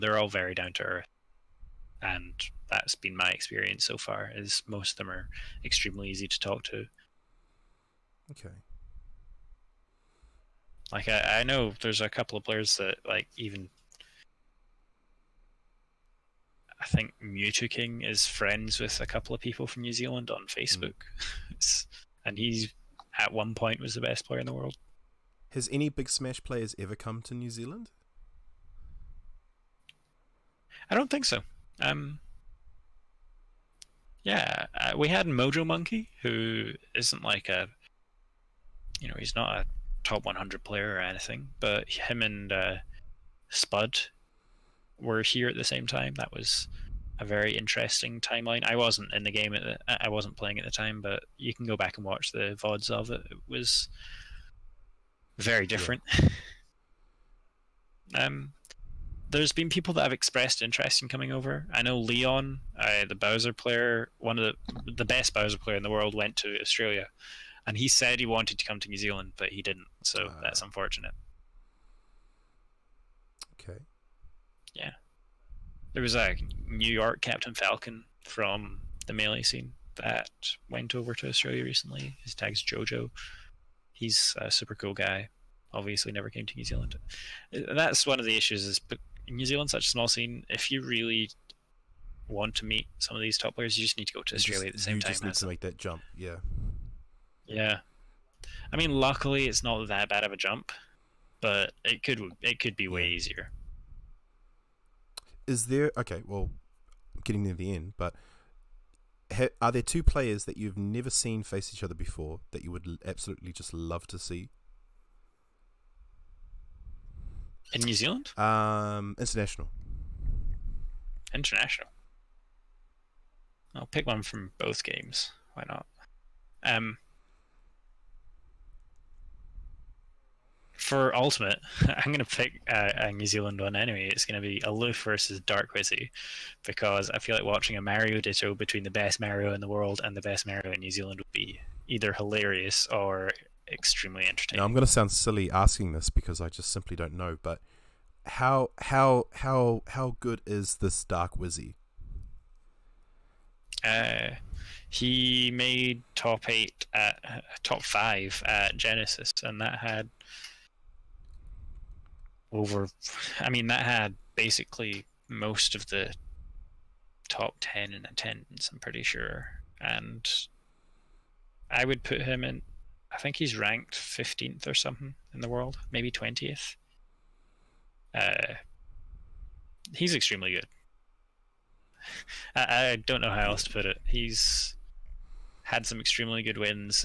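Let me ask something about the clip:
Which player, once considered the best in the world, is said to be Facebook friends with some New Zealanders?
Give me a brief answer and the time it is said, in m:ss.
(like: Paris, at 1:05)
Mewtwo King, at 0:17.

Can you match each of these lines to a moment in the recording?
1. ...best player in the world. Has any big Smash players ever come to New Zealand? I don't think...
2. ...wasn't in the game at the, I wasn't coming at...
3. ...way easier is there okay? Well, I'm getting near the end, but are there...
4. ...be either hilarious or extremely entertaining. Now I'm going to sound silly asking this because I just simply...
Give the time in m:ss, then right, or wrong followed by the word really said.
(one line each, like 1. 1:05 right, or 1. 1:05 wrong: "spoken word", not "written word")
1. 0:23 right
2. 0:48 wrong: "playing", not "coming"
3. 1:42 right
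4. 2:21 right.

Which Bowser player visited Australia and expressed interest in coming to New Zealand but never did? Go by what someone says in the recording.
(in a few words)
Leon.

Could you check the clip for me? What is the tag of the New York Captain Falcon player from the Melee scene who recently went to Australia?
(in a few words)
Jojo.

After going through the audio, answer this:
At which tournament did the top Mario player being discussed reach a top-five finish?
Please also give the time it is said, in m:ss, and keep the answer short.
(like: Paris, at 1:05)
Genesis, at 2:38.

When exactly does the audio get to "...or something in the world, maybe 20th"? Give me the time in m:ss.
2:54.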